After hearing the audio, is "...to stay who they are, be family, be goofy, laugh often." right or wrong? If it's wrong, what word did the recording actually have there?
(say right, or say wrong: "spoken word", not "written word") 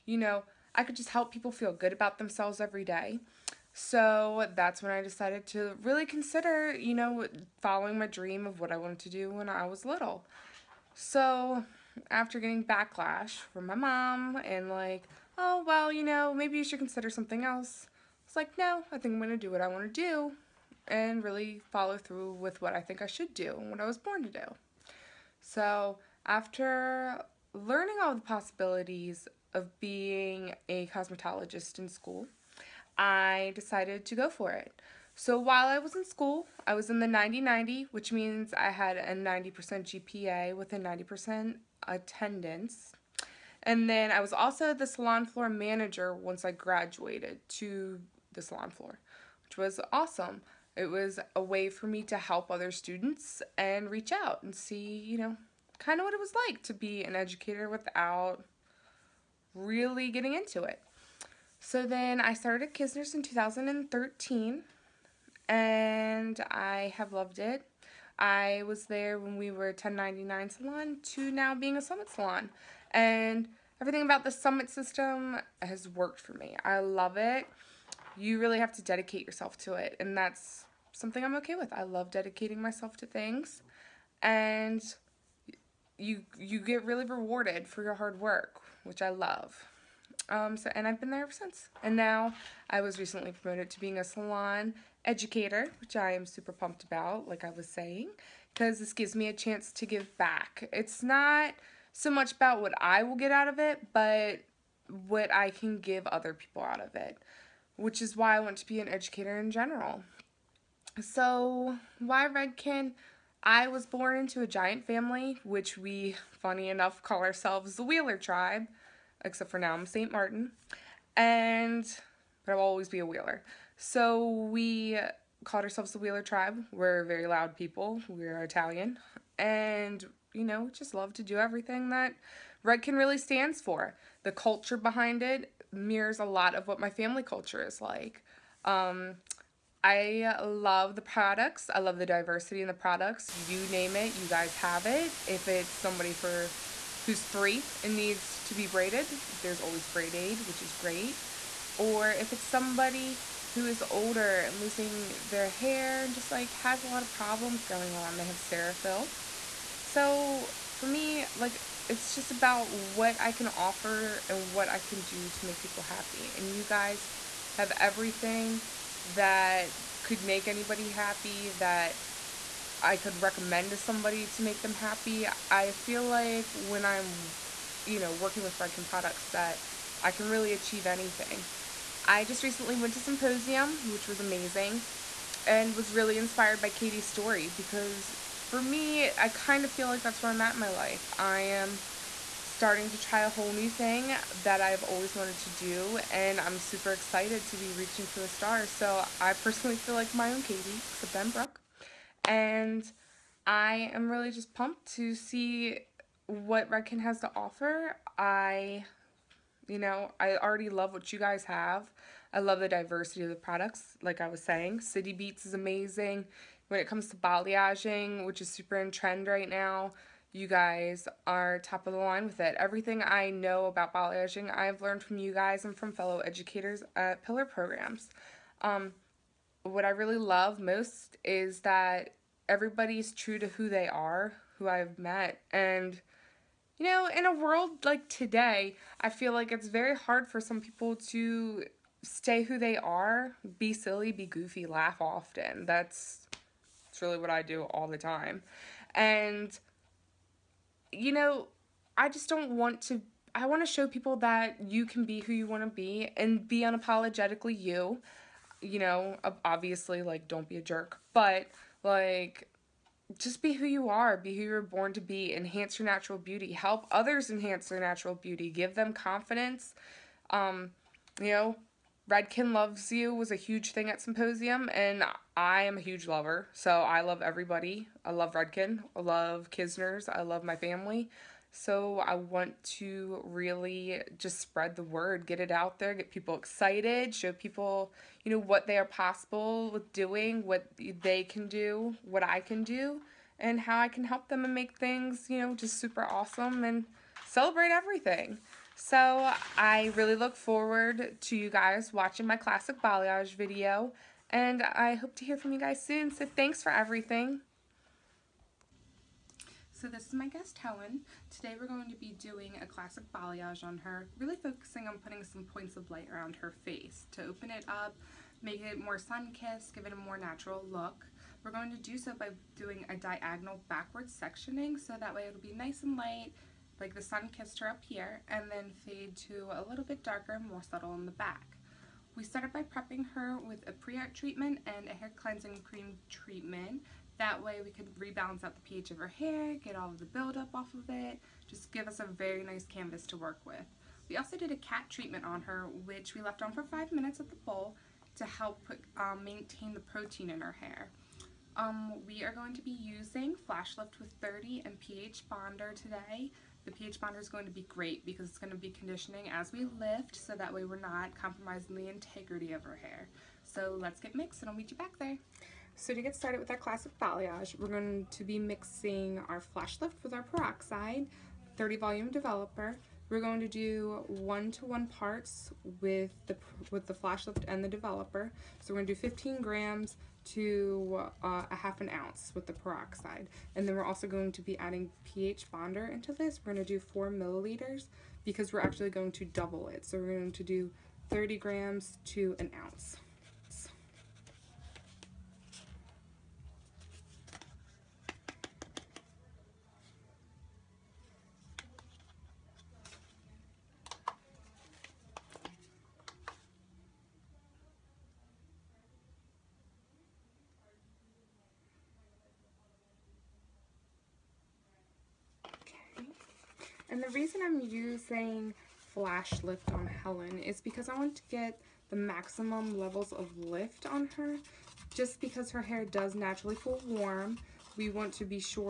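wrong: "silly", not "family".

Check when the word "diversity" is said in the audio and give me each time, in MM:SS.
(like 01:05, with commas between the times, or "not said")
02:22, 03:32.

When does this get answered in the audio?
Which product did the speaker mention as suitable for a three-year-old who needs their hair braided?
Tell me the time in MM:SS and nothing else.
02:29.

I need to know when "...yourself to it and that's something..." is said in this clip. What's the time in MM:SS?
01:19.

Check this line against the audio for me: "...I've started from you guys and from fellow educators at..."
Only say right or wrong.
wrong.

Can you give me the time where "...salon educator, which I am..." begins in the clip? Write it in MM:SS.
01:34.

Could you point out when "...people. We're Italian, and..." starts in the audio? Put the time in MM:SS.
02:07.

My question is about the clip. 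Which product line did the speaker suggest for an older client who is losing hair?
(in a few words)
Cerafill.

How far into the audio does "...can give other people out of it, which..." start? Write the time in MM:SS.
01:45.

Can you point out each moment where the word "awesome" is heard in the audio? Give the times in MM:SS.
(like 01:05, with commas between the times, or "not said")
00:49, 04:56.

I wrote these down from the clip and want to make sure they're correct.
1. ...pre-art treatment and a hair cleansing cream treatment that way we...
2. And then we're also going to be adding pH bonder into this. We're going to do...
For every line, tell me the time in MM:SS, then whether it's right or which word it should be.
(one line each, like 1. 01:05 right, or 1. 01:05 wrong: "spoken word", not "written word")
1. 05:33 right
2. 06:23 right.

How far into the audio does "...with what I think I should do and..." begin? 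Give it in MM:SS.
00:22.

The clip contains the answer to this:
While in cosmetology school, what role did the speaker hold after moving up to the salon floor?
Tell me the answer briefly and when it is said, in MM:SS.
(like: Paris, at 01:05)
Salon floor manager, at 00:44.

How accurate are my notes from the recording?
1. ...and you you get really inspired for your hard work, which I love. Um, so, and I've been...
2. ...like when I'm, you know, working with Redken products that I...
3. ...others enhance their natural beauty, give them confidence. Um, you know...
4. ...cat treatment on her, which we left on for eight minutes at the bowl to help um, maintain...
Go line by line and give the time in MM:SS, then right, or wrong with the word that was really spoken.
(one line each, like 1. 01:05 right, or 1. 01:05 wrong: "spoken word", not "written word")
1. 01:24 wrong: "rewarded", not "inspired"
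2. 02:56 right
3. 04:26 right
4. 05:44 wrong: "five", not "eight".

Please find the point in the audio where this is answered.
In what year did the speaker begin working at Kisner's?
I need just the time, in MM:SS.
01:03.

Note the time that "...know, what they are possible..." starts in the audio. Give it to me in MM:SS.
04:48.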